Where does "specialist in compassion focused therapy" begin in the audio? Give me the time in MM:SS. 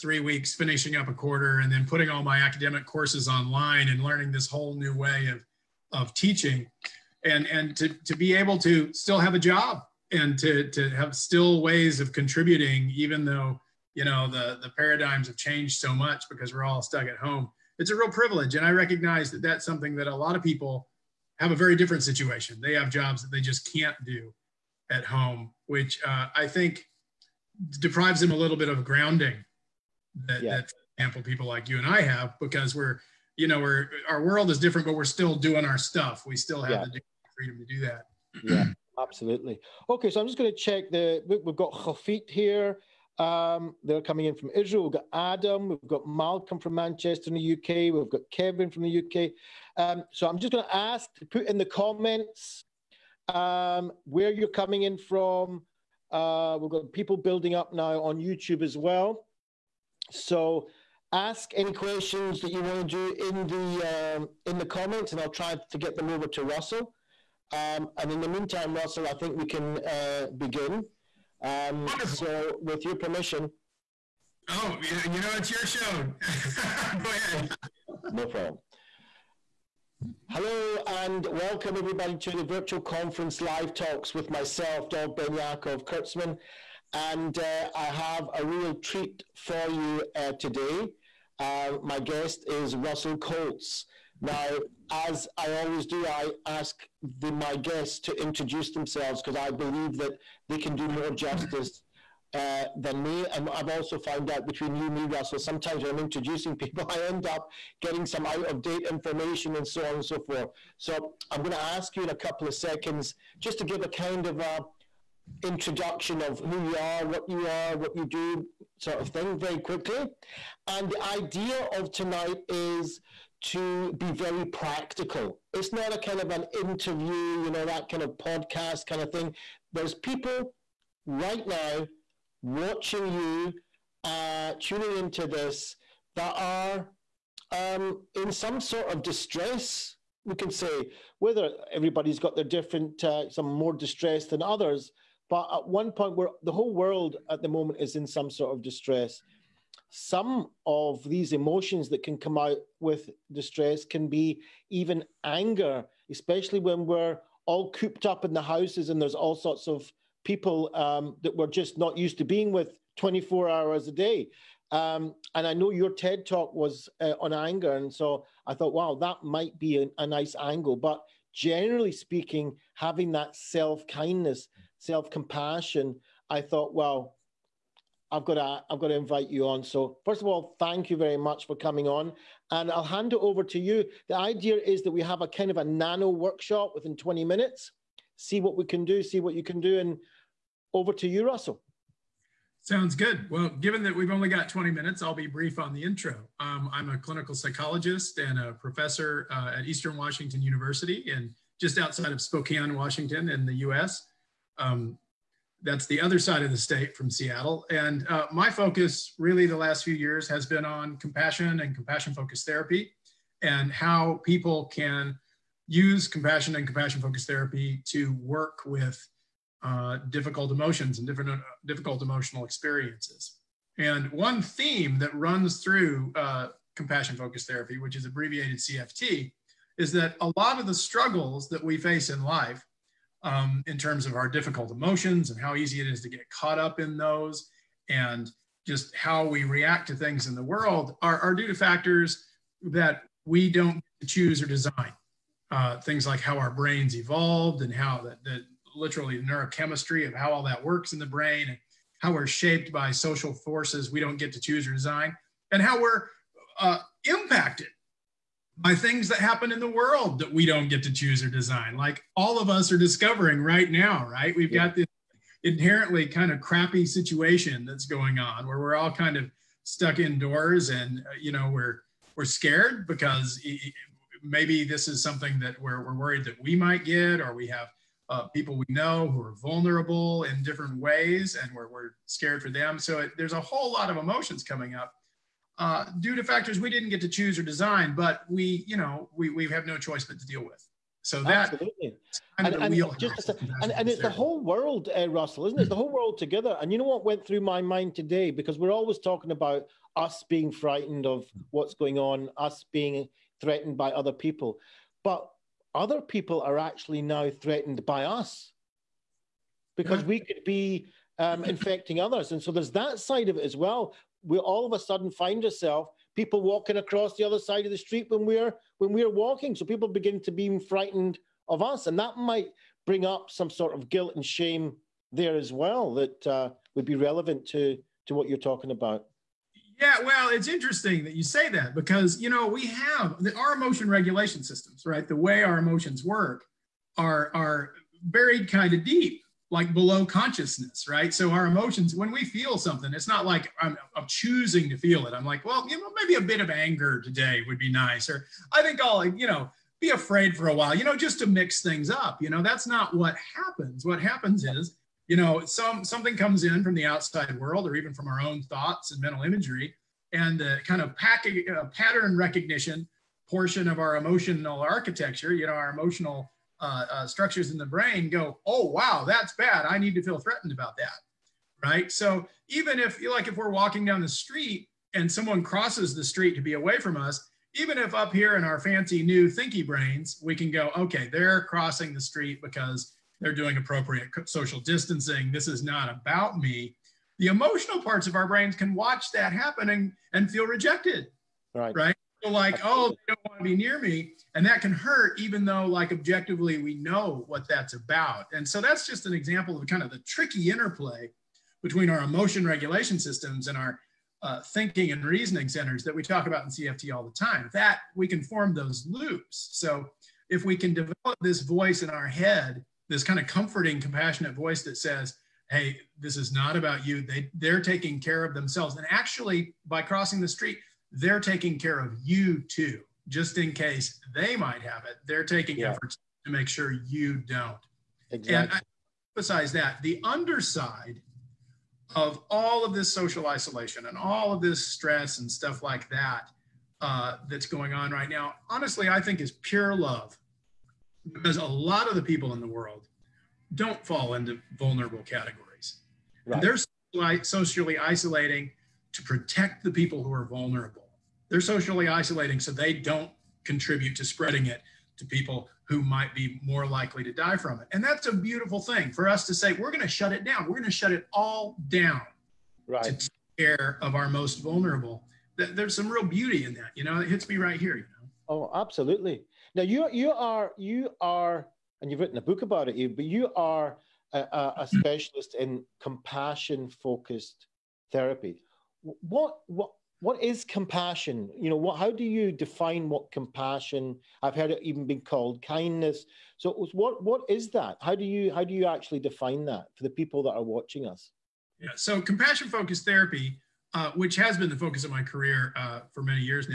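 07:54.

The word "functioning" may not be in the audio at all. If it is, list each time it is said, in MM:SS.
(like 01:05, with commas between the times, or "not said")
not said.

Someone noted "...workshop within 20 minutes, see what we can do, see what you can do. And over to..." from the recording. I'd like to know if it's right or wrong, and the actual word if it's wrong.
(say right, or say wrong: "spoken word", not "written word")
right.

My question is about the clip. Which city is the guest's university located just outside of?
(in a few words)
Spokane.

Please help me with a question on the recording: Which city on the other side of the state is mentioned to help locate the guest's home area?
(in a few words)
Seattle.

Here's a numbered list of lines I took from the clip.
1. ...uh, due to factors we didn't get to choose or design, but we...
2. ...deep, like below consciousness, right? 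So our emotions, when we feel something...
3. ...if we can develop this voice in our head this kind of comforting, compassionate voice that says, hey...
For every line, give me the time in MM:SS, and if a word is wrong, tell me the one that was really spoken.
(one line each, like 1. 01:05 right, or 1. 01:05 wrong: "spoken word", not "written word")
1. 04:45 right
2. 05:38 right
3. 06:50 right.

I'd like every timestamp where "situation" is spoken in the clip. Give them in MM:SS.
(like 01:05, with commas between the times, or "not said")
00:22, 04:26.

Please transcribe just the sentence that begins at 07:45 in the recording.
There's some real beauty in that.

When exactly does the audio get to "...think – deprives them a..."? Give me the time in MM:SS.
00:26.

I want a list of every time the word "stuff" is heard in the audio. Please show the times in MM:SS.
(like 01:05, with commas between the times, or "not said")
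00:35, 07:15.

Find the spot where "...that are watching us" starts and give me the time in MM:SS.
08:10.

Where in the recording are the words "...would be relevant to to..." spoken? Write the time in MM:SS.
05:26.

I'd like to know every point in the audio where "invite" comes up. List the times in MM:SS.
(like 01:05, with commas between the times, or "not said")
02:58.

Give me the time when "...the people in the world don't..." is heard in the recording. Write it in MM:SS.
07:21.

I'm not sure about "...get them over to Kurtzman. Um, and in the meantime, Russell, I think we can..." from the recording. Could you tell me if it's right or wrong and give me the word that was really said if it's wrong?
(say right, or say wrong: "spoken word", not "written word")
wrong: "Russell", not "Kurtzman".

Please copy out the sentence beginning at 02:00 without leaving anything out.
And the idea of tonight is to be very practical.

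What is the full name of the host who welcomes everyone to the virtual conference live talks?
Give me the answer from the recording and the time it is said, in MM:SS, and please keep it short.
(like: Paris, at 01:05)
Dov Benyaacov Kurtzman, at 01:24.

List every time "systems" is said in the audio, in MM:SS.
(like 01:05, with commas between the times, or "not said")
05:34, 06:42.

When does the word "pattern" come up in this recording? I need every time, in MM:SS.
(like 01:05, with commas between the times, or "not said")
06:01.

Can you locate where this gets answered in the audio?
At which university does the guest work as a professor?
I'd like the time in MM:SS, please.
03:19.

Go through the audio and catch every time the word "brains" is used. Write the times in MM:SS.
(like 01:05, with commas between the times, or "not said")
04:06, 04:11, 06:07, 06:19, 06:28.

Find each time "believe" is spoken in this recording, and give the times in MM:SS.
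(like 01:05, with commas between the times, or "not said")
01:39.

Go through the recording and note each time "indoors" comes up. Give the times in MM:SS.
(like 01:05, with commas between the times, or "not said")
04:29.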